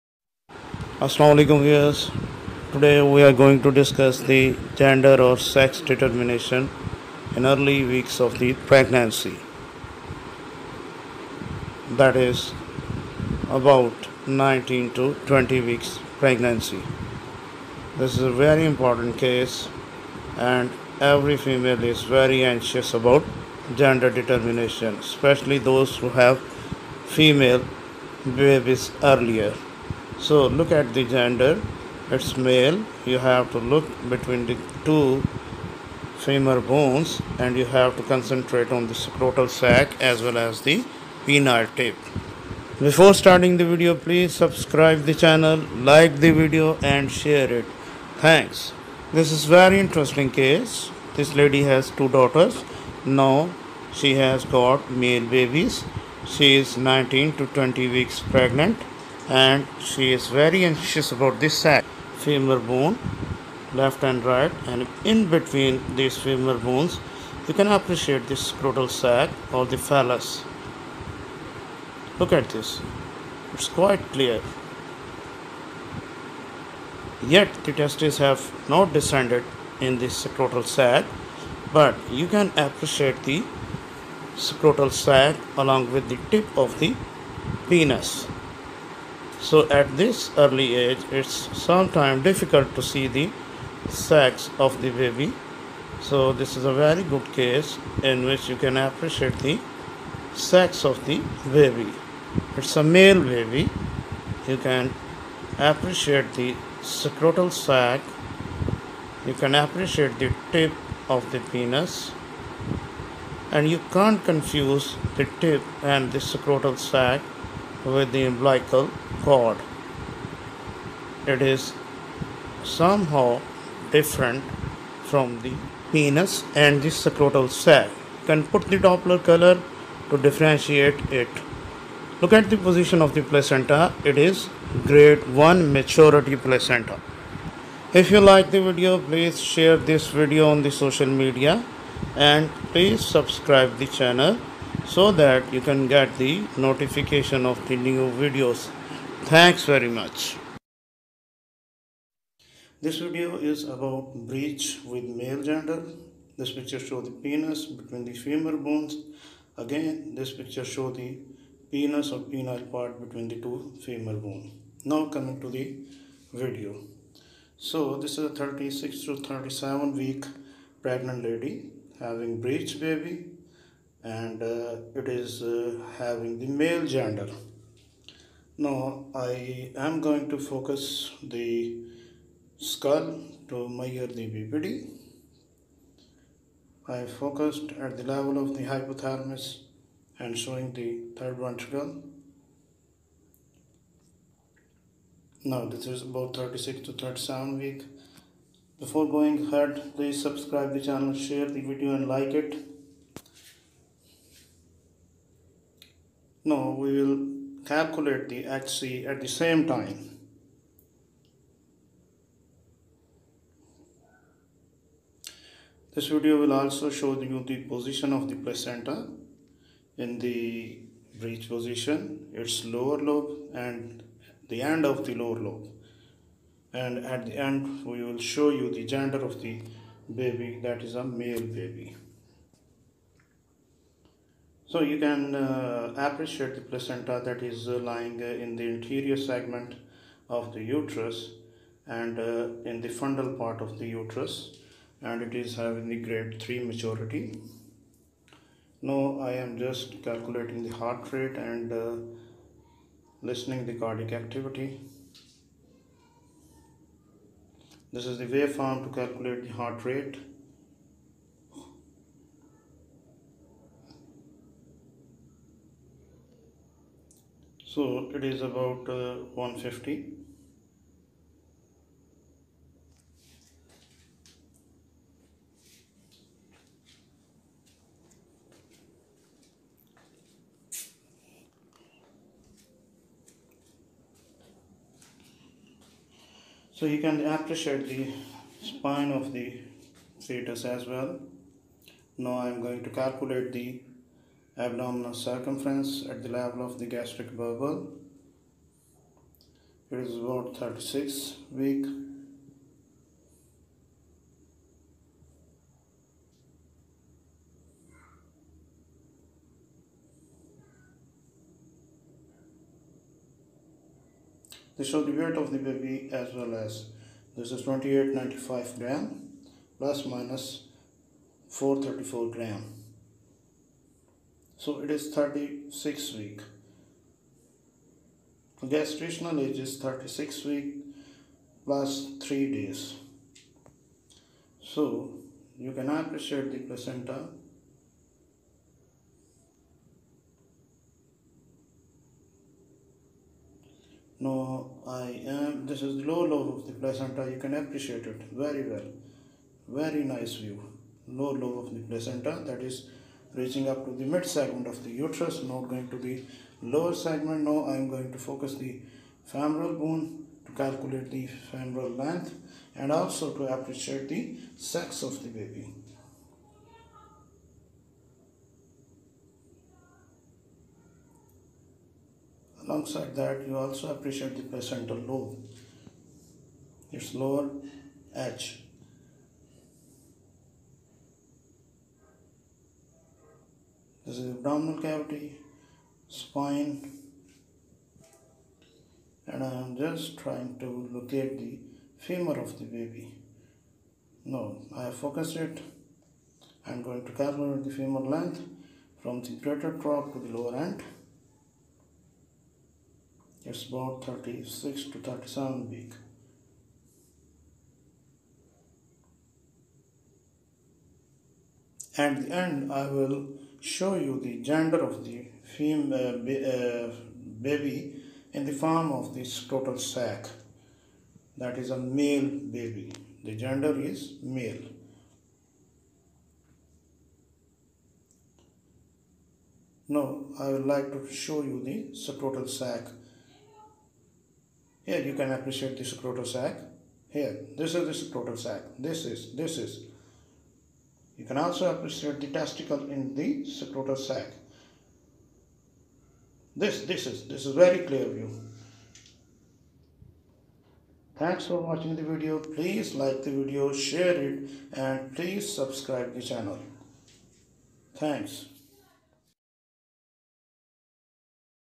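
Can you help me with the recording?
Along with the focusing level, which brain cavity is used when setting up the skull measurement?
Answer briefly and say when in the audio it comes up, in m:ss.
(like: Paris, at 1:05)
Third ventricle, at 3:11.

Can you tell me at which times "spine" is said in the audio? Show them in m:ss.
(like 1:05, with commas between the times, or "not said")
4:48, 6:26.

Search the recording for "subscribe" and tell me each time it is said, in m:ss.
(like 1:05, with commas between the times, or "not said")
0:44, 2:23, 3:20, 7:35.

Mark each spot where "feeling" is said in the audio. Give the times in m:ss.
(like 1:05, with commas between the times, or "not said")
not said.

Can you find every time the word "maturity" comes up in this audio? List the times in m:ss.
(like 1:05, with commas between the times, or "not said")
2:15, 4:06.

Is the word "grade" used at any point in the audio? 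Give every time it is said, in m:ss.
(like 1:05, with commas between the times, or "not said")
2:14, 4:05.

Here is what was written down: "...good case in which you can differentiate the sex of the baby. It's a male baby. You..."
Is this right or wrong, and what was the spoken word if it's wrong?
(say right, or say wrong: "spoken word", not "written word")
wrong: "appreciate", not "differentiate".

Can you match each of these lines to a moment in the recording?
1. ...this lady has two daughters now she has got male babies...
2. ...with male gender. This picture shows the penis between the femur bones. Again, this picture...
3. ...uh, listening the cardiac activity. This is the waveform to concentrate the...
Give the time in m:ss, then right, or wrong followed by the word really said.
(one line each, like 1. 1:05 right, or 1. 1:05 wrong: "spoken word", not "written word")
1. 0:51 right
2. 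2:34 right
3. 4:11 wrong: "calculate", not "concentrate".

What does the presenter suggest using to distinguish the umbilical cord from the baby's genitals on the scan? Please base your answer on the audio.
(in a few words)
Doppler color.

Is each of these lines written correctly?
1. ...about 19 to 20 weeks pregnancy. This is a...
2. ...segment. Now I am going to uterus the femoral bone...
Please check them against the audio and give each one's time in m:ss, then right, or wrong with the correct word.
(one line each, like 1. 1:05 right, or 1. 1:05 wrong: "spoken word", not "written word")
1. 0:13 right
2. 5:56 wrong: "focus", not "uterus".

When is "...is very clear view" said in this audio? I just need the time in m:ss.
7:27.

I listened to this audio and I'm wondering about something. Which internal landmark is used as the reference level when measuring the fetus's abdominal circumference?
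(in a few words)
Gastric bubble.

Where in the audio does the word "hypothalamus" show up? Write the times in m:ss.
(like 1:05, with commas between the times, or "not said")
3:08.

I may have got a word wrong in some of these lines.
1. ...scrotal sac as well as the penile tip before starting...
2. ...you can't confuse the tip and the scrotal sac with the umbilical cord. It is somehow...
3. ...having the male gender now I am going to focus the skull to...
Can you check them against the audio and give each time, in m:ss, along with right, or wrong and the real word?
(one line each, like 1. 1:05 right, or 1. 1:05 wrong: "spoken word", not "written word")
1. 0:38 right
2. 1:53 right
3. 2:55 right.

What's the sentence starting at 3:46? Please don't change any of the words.
And at the end, we will show you the gender of the baby that is a male baby.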